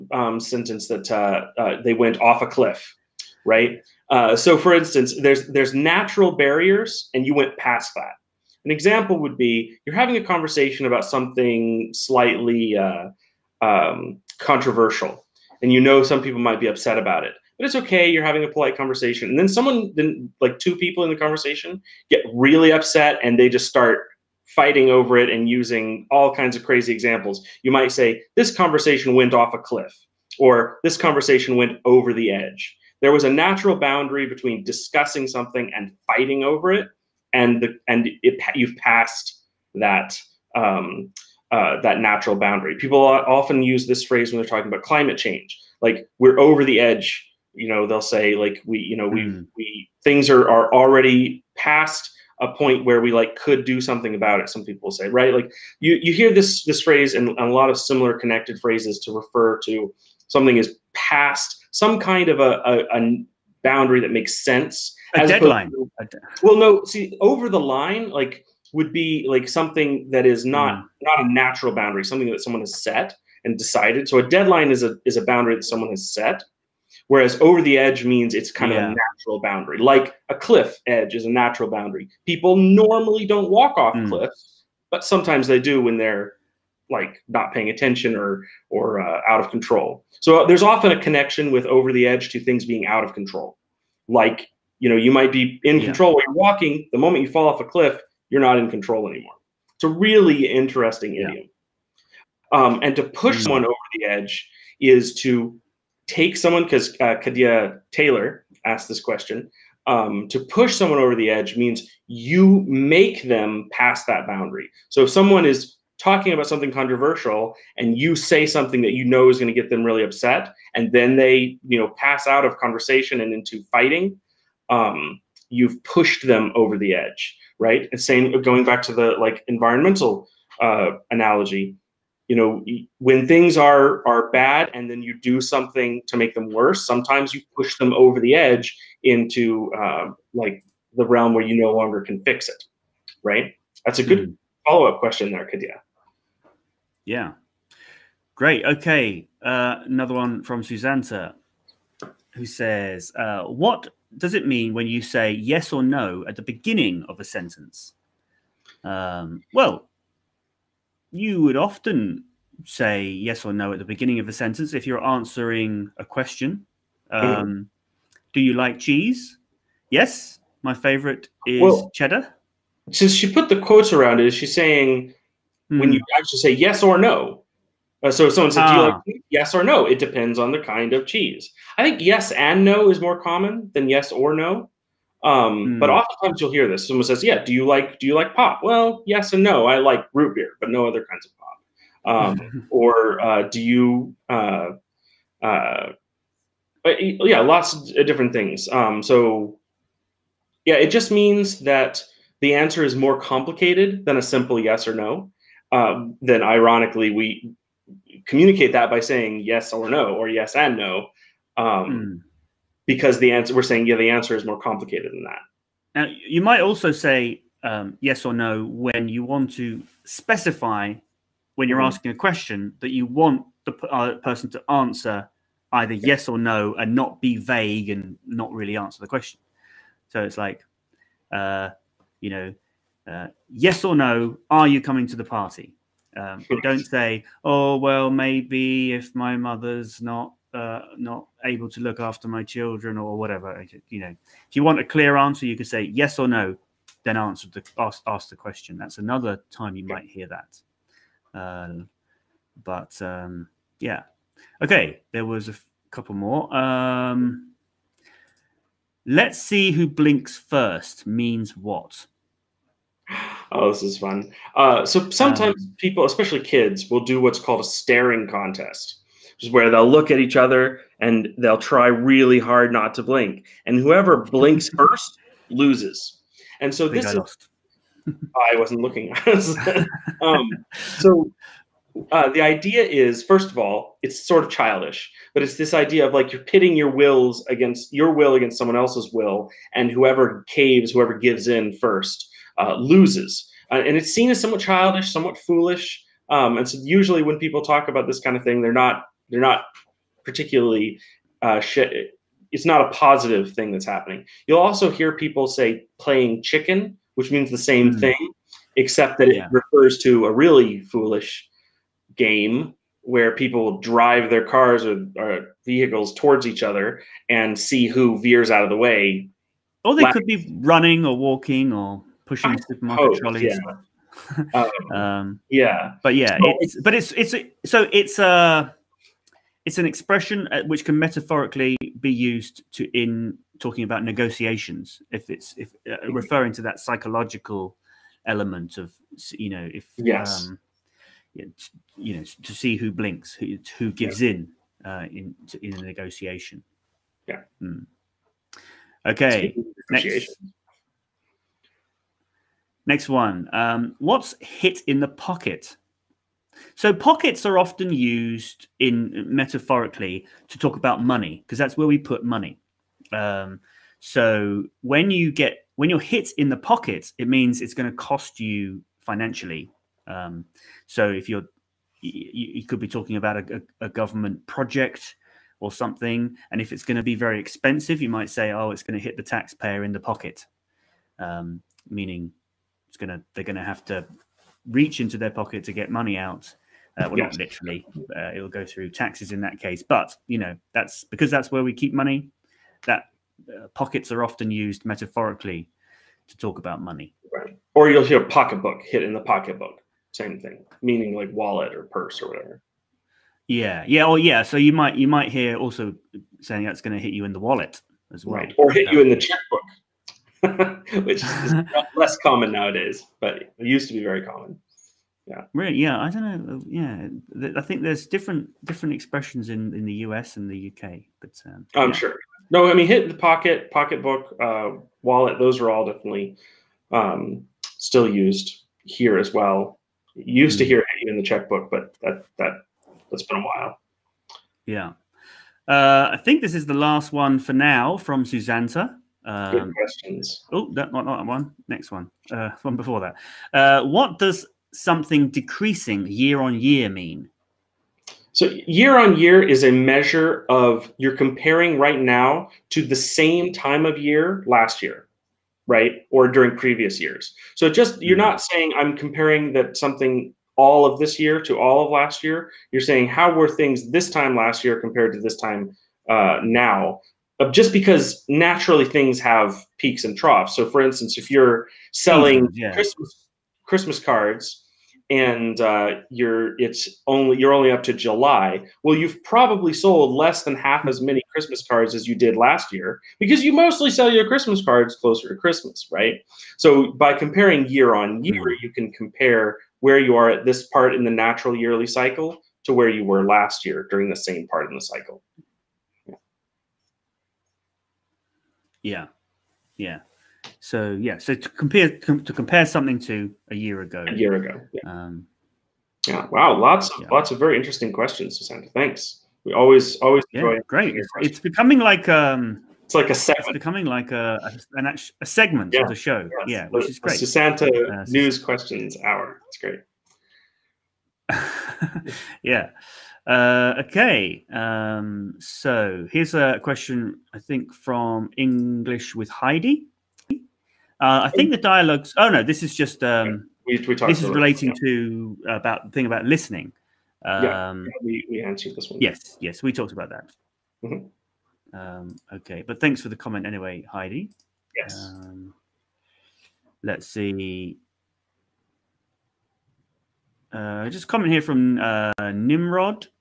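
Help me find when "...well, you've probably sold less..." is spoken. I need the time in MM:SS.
07:58.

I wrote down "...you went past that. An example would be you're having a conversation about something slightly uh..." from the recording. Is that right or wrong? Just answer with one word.
right.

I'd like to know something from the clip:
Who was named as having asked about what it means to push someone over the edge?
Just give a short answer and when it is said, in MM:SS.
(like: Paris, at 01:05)
Kadia Taylor, at 01:47.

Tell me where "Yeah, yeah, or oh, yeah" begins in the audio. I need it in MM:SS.
06:43.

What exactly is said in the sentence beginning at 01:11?
not a natural boundary, something that someone has set and decided.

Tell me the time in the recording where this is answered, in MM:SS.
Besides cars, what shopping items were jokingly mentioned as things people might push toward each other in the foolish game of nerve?
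05:22.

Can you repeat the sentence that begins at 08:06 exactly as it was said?
So, by comparing year on year, mm-hmm.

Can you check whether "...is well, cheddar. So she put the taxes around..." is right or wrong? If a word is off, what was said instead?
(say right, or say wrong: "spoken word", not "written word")
wrong: "quotes", not "taxes".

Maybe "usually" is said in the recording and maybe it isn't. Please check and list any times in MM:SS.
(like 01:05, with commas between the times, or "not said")
04:56.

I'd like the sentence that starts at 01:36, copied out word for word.
The moment you fall off a cliff, you're not in control anymore.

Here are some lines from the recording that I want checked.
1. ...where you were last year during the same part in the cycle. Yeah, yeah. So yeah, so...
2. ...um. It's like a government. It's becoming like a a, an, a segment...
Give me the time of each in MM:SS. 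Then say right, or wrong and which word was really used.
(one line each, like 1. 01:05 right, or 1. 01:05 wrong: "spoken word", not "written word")
1. 08:12 right
2. 08:32 wrong: "segment", not "government".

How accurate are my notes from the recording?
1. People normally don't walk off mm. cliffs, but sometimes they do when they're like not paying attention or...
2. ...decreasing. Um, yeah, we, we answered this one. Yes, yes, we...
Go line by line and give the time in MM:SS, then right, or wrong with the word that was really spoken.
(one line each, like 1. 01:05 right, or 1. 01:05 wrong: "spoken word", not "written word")
1. 01:22 right
2. 08:56 wrong: "listening", not "decreasing".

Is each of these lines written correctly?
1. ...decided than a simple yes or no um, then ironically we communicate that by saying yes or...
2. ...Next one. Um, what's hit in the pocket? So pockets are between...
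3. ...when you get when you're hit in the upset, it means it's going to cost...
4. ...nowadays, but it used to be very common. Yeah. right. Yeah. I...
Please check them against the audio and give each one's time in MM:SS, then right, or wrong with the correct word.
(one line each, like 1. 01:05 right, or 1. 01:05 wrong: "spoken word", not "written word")
1. 03:23 wrong: "complicated", not "decided"
2. 05:52 wrong: "often", not "between"
3. 06:04 wrong: "pocket", not "upset"
4. 06:52 right.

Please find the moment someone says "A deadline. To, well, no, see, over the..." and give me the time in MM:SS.
01:05.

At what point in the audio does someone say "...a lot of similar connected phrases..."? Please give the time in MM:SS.
00:57.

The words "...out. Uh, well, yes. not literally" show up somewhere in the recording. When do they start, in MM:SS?
06:26.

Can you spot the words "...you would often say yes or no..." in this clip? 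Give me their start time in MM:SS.
02:41.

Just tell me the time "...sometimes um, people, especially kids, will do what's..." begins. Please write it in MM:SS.
04:25.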